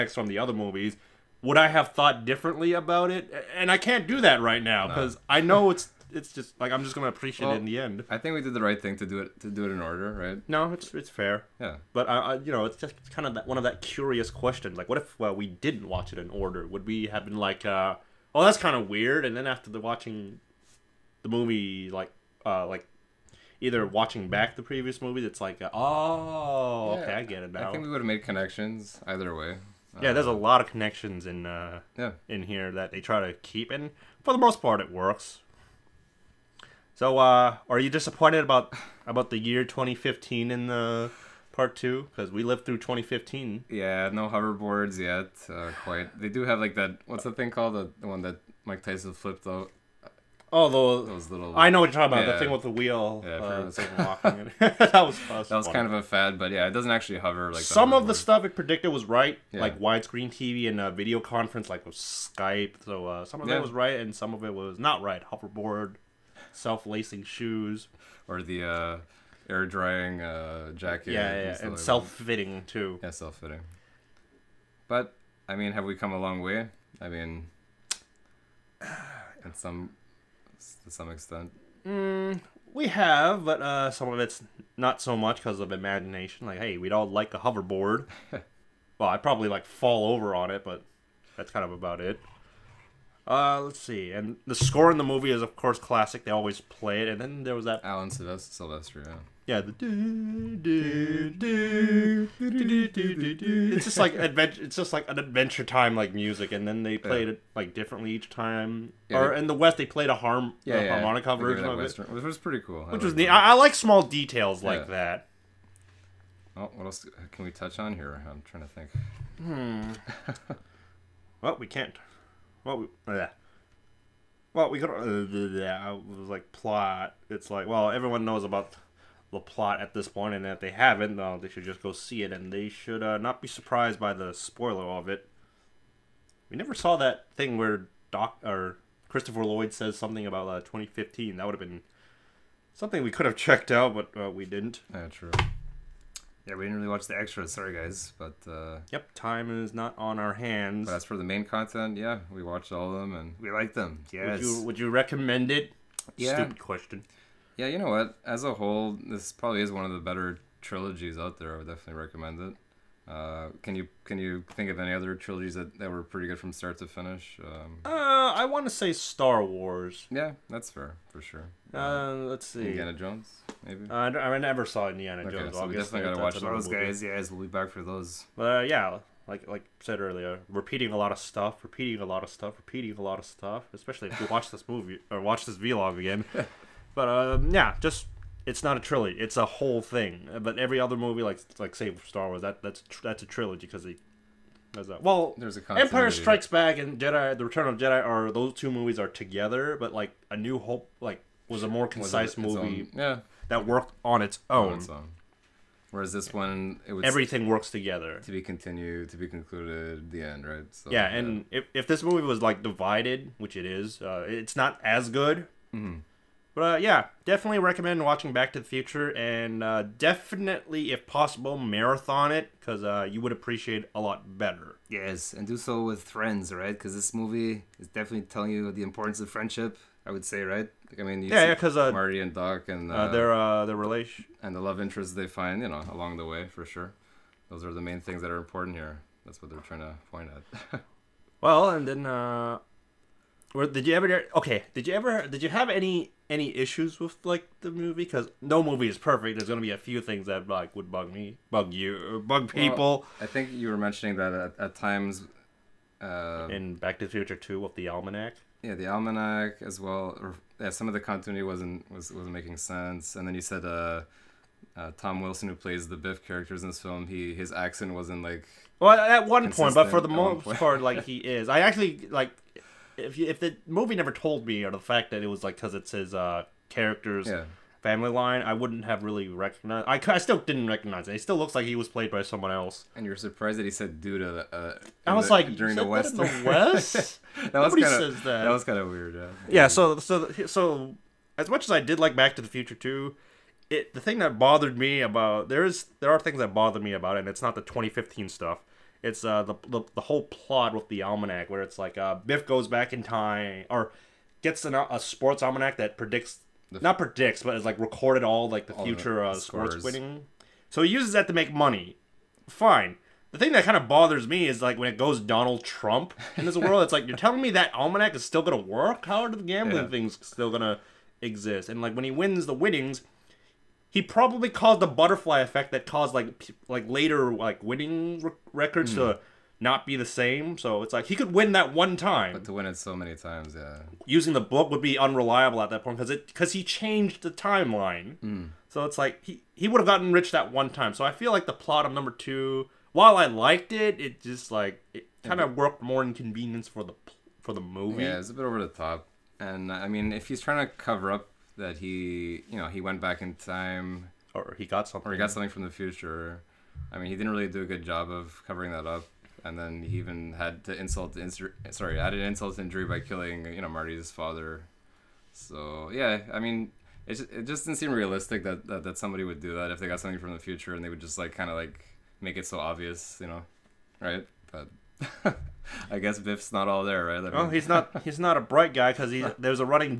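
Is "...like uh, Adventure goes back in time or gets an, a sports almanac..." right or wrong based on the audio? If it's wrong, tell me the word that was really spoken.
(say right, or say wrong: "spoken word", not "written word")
wrong: "Biff", not "Adventure".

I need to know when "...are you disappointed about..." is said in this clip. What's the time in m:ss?
0:37.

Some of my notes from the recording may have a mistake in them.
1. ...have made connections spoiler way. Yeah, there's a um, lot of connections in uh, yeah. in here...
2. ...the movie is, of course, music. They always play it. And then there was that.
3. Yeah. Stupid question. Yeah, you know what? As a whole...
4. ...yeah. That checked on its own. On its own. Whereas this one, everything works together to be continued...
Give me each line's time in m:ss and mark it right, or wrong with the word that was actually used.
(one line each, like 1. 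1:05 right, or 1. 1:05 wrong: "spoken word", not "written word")
1. 0:28 wrong: "either", not "spoiler"
2. 1:34 wrong: "classic", not "music"
3. 2:36 right
4. 3:22 wrong: "worked", not "checked".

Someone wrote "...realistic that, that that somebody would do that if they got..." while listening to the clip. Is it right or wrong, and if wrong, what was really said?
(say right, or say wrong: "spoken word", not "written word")
right.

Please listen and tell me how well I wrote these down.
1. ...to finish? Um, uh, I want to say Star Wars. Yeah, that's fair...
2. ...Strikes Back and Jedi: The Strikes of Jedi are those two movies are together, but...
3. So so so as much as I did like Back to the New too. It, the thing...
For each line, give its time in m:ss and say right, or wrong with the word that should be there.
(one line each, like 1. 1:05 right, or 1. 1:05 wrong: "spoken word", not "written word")
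1. 2:46 right
2. 3:16 wrong: "Return", not "Strikes"
3. 4:49 wrong: "Future", not "New".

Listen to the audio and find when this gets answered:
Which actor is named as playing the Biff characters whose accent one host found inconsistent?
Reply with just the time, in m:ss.
4:24.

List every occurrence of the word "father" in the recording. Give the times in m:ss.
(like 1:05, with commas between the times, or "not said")
6:04.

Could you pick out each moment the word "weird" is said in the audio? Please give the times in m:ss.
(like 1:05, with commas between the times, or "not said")
0:18, 4:48.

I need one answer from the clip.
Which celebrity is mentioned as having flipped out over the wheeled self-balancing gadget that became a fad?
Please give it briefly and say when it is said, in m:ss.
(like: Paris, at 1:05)
Mike Tyson, at 0:48.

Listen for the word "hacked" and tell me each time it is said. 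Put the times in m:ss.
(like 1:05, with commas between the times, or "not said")
not said.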